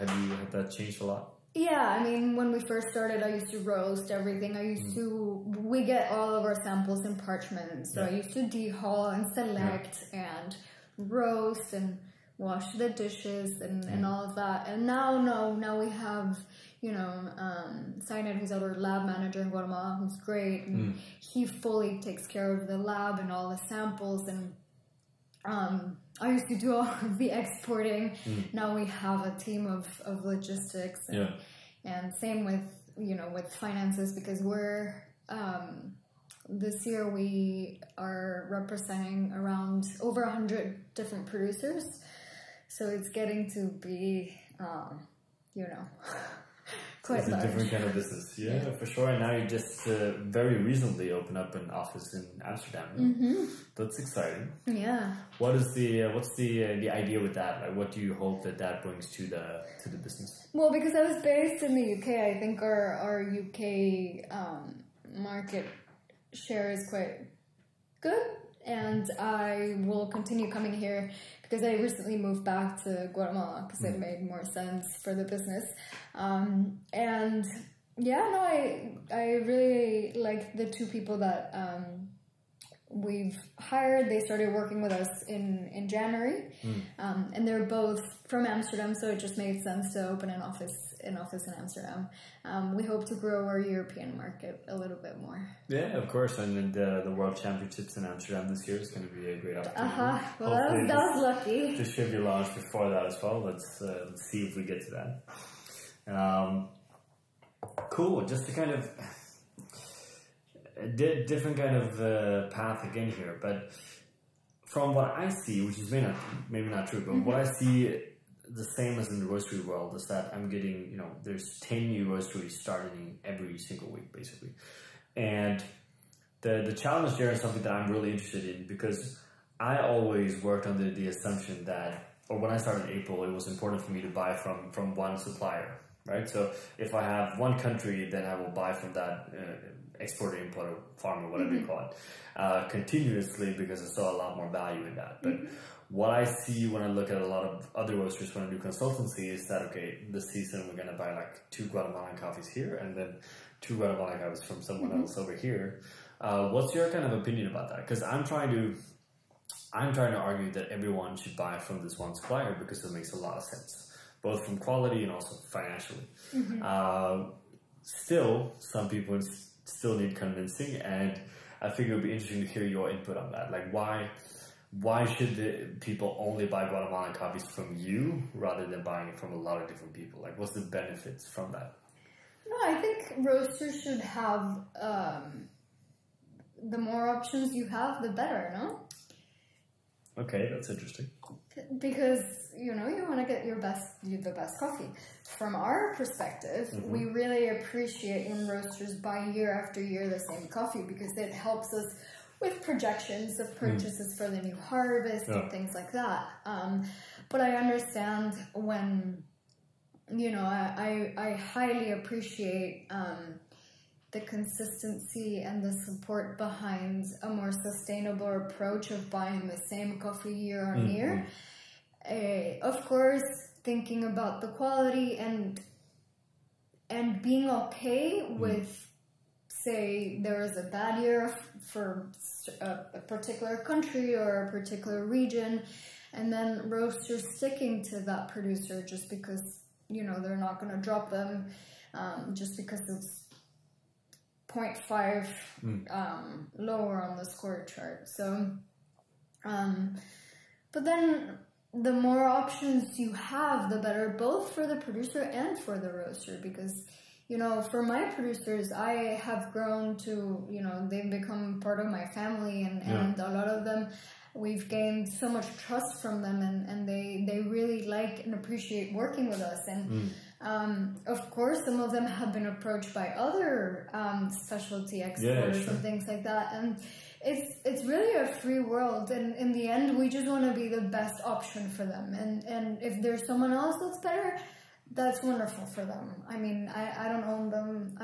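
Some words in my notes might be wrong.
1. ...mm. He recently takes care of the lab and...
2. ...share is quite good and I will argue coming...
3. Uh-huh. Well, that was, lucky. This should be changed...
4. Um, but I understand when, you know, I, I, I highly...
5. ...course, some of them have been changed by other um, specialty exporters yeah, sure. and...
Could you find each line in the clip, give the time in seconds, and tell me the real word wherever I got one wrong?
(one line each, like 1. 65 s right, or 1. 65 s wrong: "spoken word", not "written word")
1. 20 s wrong: "fully", not "recently"
2. 66 s wrong: "continue", not "argue"
3. 100 s wrong: "launched", not "changed"
4. 206 s right
5. 271 s wrong: "approached", not "changed".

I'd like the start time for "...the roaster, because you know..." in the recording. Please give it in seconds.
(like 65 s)
255 s.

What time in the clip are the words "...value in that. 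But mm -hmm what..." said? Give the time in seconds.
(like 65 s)
144 s.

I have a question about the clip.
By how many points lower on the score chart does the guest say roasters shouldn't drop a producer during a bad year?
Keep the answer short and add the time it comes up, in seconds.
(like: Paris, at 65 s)
0.5, at 244 s.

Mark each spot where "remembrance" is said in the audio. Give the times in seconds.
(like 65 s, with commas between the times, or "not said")
not said.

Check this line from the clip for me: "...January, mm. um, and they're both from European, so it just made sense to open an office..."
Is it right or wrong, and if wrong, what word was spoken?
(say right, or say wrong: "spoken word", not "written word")
wrong: "Amsterdam", not "European".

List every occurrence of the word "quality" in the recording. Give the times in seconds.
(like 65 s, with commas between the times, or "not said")
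164 s, 224 s.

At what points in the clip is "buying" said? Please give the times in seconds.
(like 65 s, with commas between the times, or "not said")
178 s, 219 s.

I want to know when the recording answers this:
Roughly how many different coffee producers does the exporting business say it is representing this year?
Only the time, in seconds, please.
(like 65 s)
40 s.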